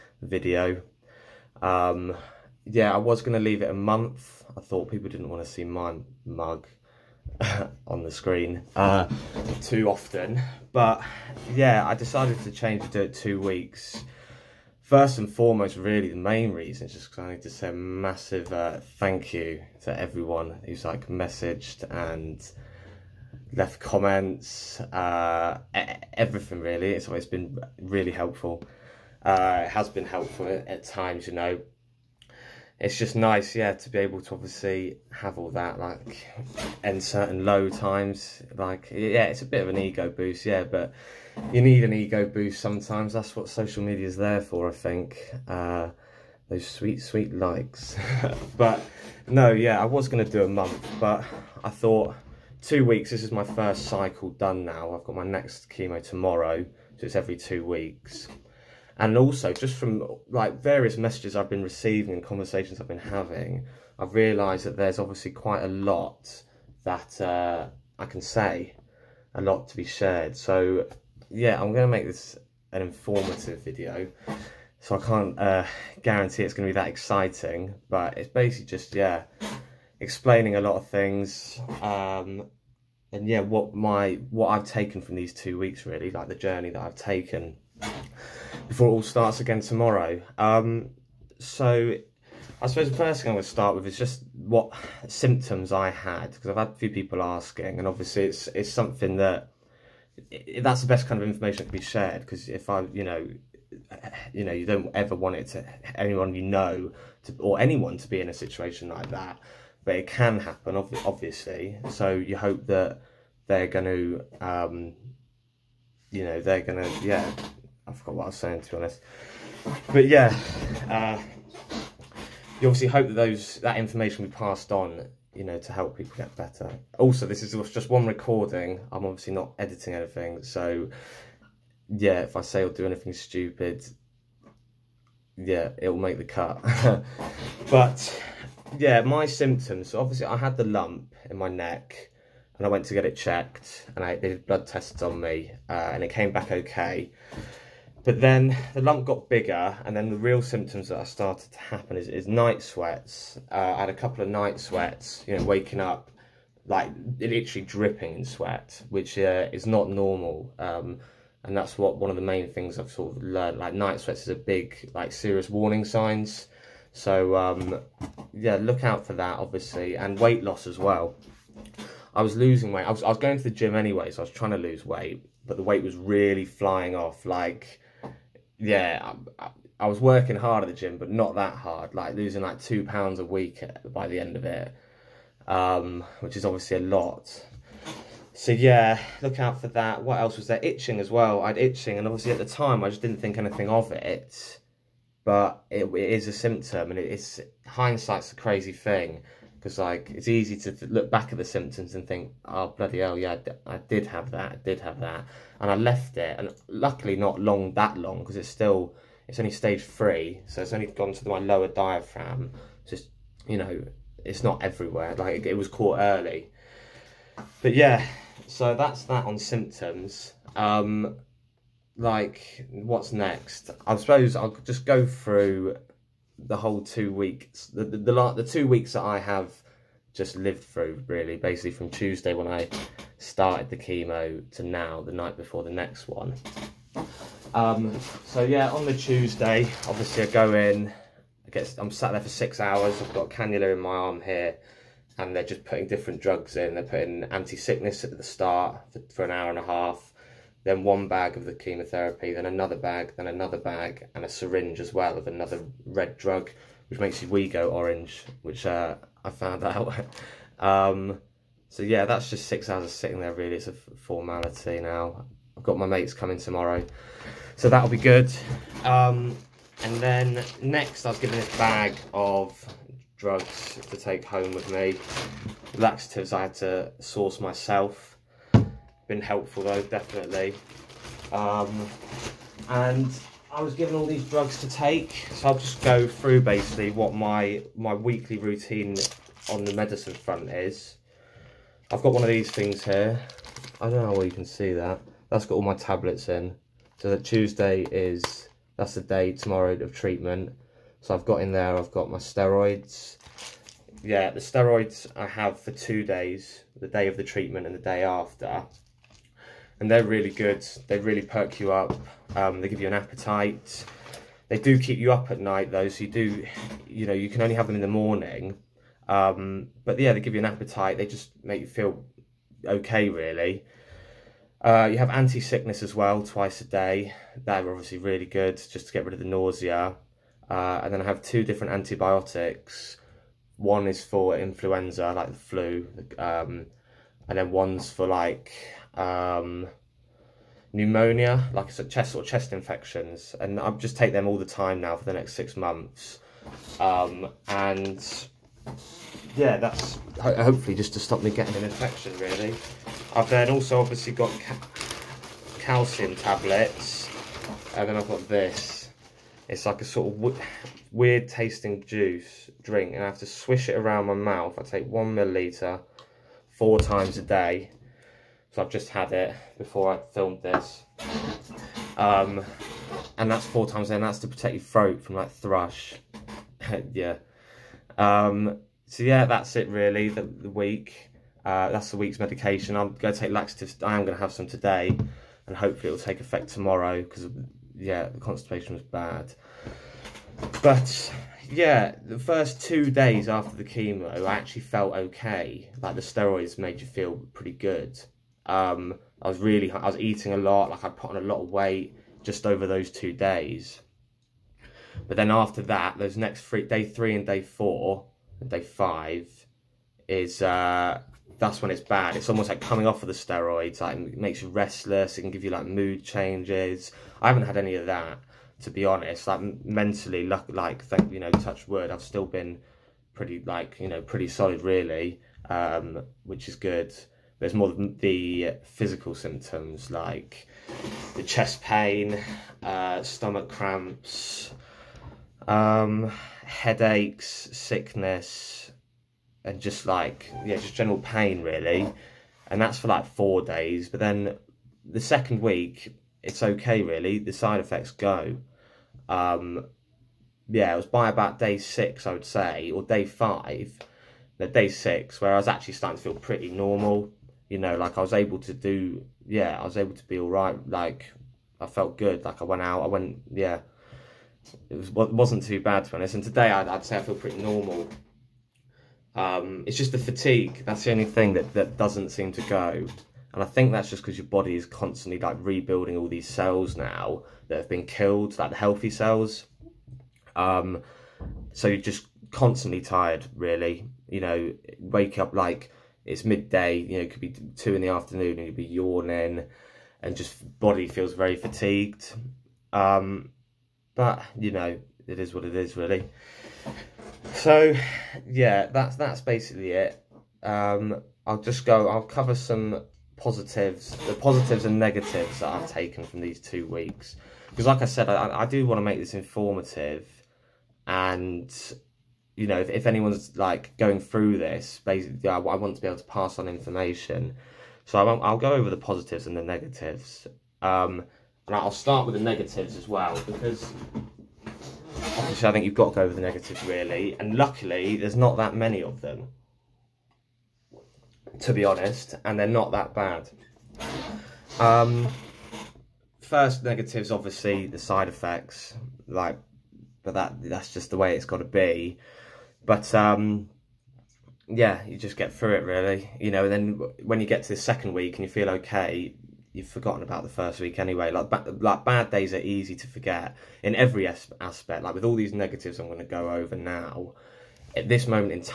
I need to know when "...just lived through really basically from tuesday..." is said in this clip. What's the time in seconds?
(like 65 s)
230 s.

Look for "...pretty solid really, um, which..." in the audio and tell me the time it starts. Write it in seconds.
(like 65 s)
424 s.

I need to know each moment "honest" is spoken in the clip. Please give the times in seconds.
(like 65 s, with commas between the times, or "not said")
118 s, 418 s, 465 s, 531 s.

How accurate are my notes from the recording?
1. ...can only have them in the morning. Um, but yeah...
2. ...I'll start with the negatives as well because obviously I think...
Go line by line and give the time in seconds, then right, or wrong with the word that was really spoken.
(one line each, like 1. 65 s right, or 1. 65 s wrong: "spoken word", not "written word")
1. 317 s right
2. 521 s right.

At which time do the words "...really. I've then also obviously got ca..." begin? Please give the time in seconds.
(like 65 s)
352 s.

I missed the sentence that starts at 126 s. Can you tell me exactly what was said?
Also, this is just one recording.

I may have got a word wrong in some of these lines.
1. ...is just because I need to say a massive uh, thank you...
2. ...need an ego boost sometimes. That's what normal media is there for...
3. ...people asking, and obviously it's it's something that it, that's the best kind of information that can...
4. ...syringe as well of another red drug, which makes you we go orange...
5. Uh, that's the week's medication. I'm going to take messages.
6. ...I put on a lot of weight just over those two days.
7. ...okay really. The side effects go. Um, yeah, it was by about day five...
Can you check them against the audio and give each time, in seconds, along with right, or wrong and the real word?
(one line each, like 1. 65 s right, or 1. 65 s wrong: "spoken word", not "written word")
1. 16 s right
2. 41 s wrong: "social", not "normal"
3. 96 s right
4. 254 s right
5. 381 s wrong: "laxatives", not "messages"
6. 400 s right
7. 446 s wrong: "six", not "five".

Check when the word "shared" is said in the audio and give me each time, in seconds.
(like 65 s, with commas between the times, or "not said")
69 s, 101 s.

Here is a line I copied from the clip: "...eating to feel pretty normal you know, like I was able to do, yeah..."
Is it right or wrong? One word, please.
wrong.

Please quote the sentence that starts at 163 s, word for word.
Like night sweats is a big, like serious warning signs.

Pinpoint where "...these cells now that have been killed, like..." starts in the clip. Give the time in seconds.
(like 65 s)
476 s.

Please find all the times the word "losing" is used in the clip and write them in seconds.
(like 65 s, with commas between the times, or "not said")
172 s, 182 s.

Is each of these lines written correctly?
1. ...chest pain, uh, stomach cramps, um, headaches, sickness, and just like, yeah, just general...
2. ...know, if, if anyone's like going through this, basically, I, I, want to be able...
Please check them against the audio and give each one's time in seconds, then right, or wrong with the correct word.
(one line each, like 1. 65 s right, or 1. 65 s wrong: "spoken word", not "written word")
1. 431 s right
2. 512 s right.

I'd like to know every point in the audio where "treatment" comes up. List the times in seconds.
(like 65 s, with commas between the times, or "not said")
299 s, 307 s.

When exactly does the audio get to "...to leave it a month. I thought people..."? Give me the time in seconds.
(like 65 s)
3 s.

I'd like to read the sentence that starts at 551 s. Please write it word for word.
Like ba- like bad days are easy to forget in every as- aspect.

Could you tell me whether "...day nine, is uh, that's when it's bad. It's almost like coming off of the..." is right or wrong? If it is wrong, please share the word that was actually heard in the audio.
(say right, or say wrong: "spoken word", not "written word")
wrong: "five", not "nine".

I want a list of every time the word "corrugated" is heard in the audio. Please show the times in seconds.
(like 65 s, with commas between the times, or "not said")
not said.